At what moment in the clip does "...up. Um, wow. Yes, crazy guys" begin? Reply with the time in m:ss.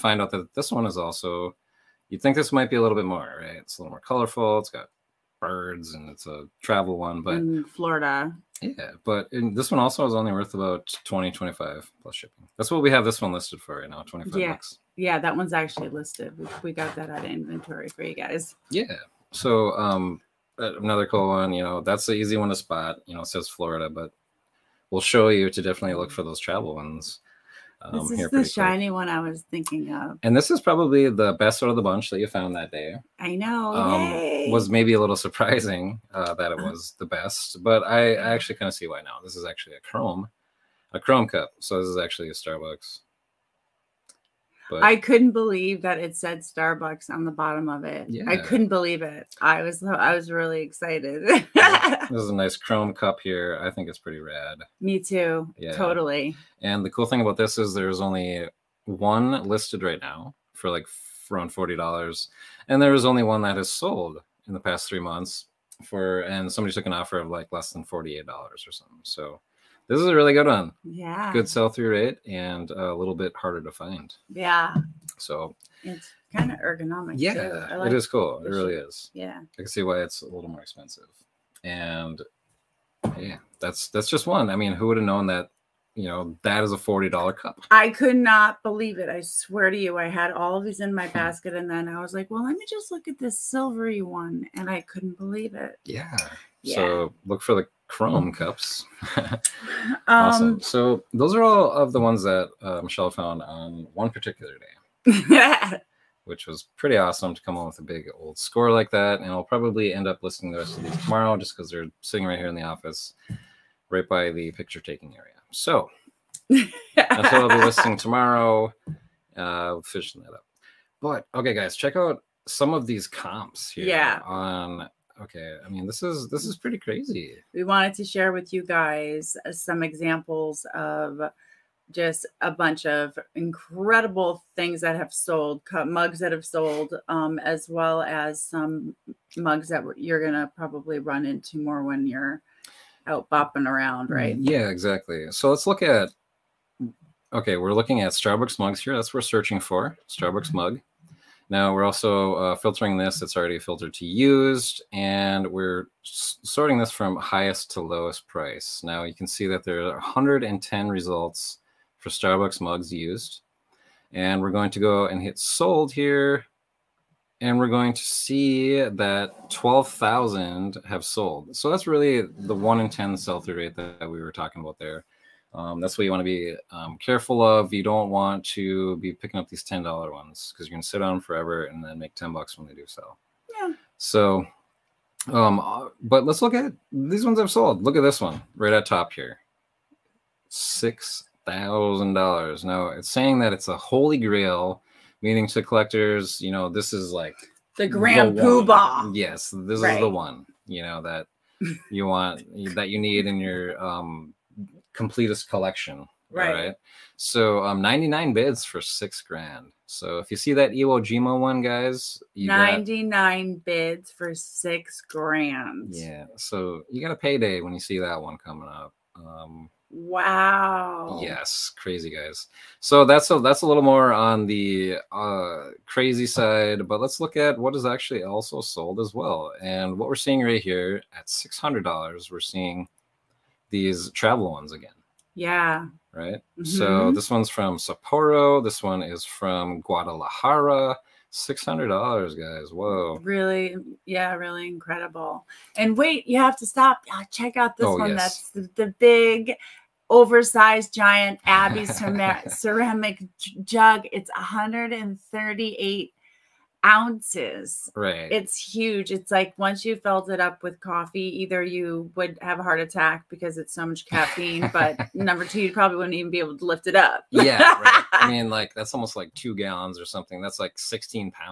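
3:38.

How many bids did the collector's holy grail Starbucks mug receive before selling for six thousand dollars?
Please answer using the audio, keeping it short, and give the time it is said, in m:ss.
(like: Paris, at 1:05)
99, at 3:27.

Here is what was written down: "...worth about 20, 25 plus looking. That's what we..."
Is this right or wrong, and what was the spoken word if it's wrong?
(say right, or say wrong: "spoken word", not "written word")
wrong: "shipping", not "looking".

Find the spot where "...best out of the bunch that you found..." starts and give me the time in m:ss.
0:31.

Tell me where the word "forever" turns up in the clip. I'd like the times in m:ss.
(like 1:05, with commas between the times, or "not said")
3:01.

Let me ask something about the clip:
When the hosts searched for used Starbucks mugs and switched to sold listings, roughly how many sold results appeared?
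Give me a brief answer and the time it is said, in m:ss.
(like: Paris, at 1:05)
12,000, at 2:49.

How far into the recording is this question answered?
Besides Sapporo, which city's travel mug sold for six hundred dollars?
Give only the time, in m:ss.
3:59.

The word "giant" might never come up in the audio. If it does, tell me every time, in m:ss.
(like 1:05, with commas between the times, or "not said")
4:10.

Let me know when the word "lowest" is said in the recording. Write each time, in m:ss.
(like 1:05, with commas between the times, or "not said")
2:37.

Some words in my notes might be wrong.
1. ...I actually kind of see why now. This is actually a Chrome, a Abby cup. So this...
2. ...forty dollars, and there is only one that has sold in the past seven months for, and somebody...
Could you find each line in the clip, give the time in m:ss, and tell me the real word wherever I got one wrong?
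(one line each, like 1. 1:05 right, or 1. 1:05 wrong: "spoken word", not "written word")
1. 0:38 wrong: "Chrome", not "Abby"
2. 1:01 wrong: "three", not "seven".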